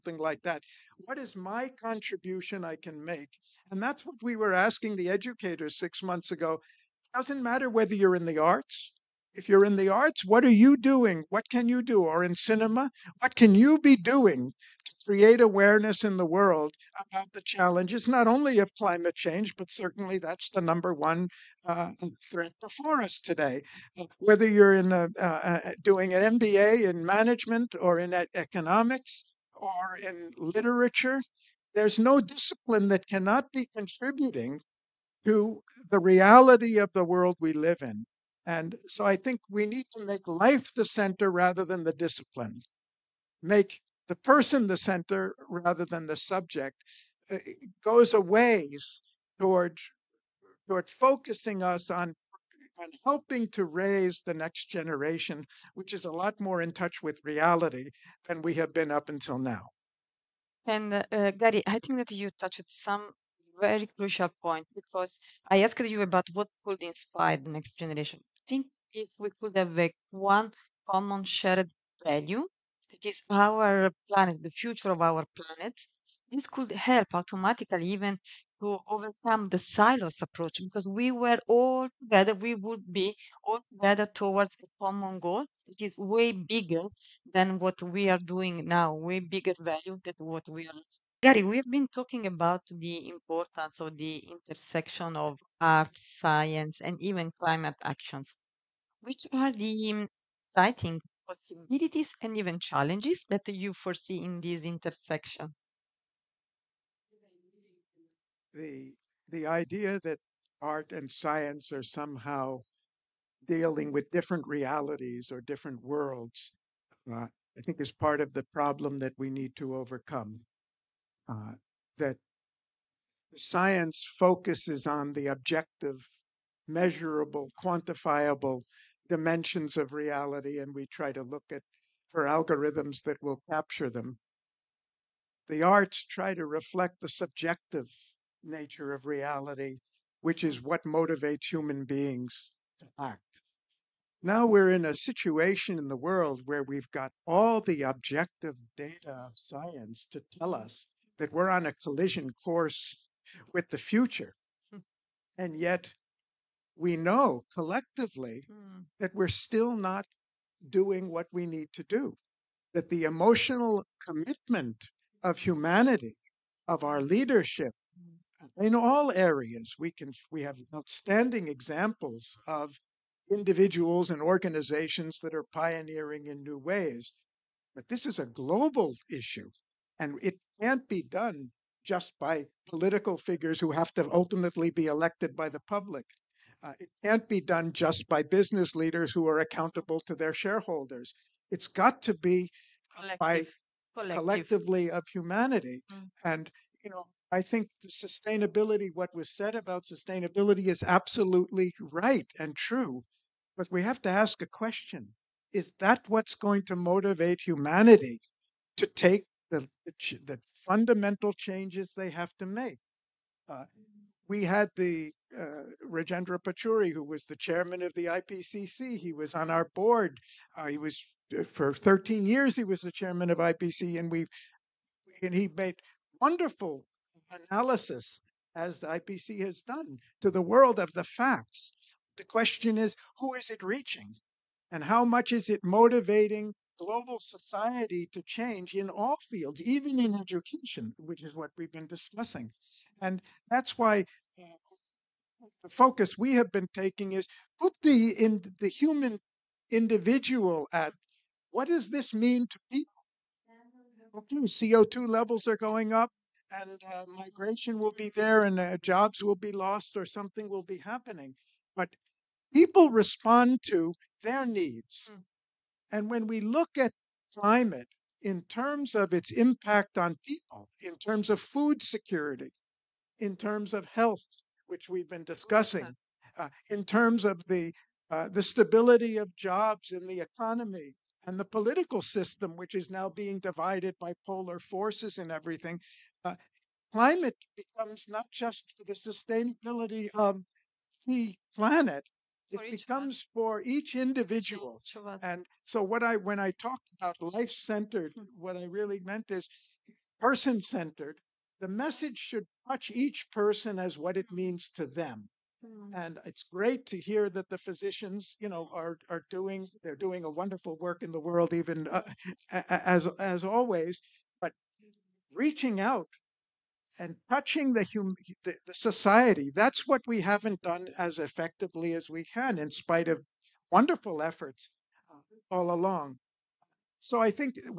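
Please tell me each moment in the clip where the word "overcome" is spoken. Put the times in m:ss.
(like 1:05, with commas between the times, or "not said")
1:18, 1:59.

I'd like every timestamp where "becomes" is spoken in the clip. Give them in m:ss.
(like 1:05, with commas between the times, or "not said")
4:47, 4:52.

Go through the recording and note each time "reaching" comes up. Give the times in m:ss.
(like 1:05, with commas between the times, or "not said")
3:53, 5:15.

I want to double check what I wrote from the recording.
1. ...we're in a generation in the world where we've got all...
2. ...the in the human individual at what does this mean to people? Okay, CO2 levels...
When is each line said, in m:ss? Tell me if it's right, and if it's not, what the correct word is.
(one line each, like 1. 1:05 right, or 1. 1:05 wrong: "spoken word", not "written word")
1. 2:24 wrong: "situation", not "generation"
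2. 4:07 right.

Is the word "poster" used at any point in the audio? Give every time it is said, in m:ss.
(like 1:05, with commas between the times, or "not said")
not said.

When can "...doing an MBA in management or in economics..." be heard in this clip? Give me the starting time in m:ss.
0:25.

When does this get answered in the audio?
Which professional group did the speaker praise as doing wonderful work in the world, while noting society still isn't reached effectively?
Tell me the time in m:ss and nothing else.
5:07.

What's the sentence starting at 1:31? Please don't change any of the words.
Garry, we've been talking about the importance of the intersection of art, science, and even climate actions.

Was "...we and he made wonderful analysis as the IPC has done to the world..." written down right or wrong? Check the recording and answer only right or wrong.
right.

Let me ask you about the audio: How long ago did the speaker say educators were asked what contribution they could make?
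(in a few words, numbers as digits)
six months ago.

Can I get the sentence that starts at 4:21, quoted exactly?
But people respond to their needs.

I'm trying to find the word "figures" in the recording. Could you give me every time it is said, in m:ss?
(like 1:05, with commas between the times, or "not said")
3:03.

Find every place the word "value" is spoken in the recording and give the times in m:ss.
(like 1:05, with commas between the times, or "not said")
1:12, 1:29.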